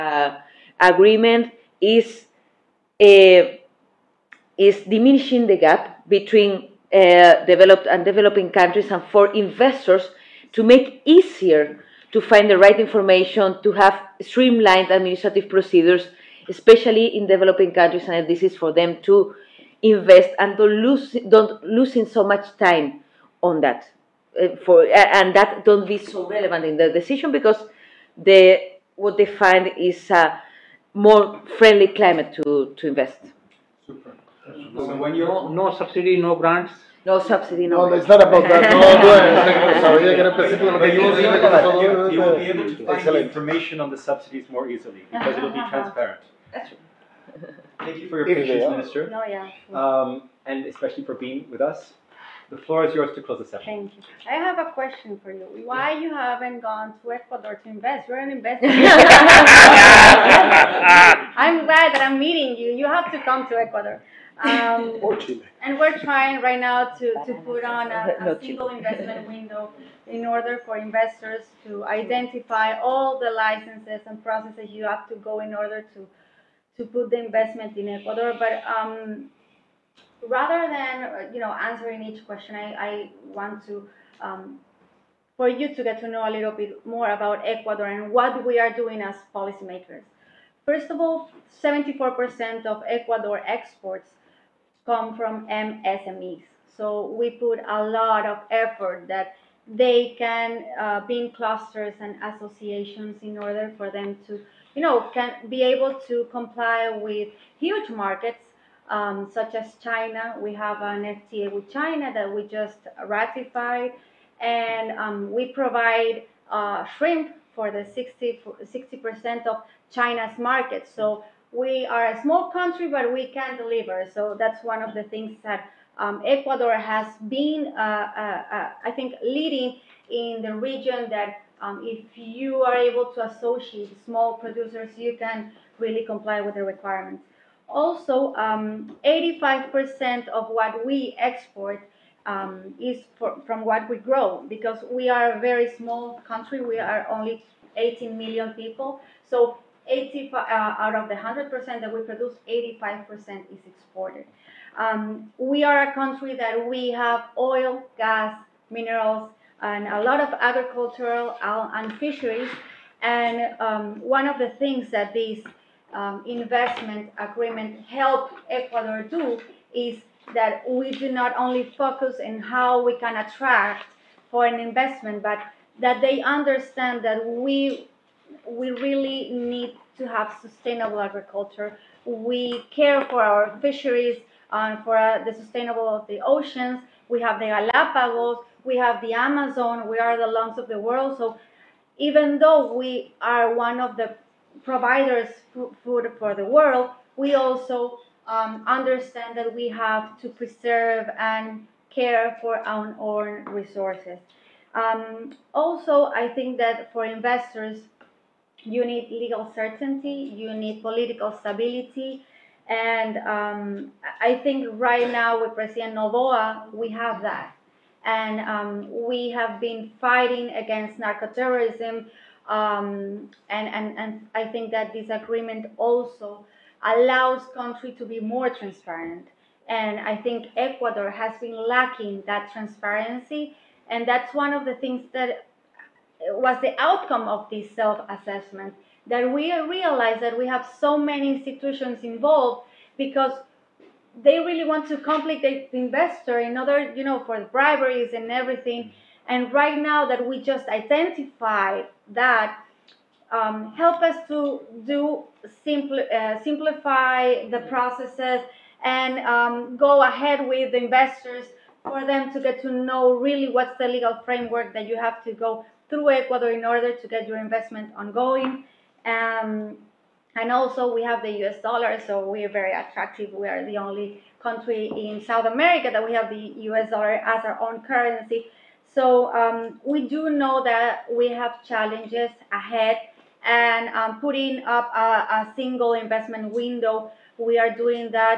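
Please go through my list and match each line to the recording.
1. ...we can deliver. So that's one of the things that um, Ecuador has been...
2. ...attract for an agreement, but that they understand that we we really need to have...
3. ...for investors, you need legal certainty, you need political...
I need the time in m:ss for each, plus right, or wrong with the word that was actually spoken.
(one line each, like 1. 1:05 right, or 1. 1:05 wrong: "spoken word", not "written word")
1. 2:03 right
2. 2:53 wrong: "investment", not "agreement"
3. 3:26 right.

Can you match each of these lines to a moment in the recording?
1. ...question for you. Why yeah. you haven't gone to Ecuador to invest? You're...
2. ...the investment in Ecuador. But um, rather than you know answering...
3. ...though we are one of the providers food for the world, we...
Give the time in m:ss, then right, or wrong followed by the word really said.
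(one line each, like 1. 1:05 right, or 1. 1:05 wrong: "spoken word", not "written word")
1. 0:54 right
2. 1:17 right
3. 3:12 right.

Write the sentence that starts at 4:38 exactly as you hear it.
So um, we do know that we have challenges ahead and um, putting up a, a, single investment window.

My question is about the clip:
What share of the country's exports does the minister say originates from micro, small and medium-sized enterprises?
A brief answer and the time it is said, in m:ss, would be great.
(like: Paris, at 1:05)
74%, at 1:31.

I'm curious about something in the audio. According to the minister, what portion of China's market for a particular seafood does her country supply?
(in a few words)
60 percent.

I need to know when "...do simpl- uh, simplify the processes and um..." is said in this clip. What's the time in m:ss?
4:14.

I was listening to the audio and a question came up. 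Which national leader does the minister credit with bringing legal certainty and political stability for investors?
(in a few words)
President Noboa.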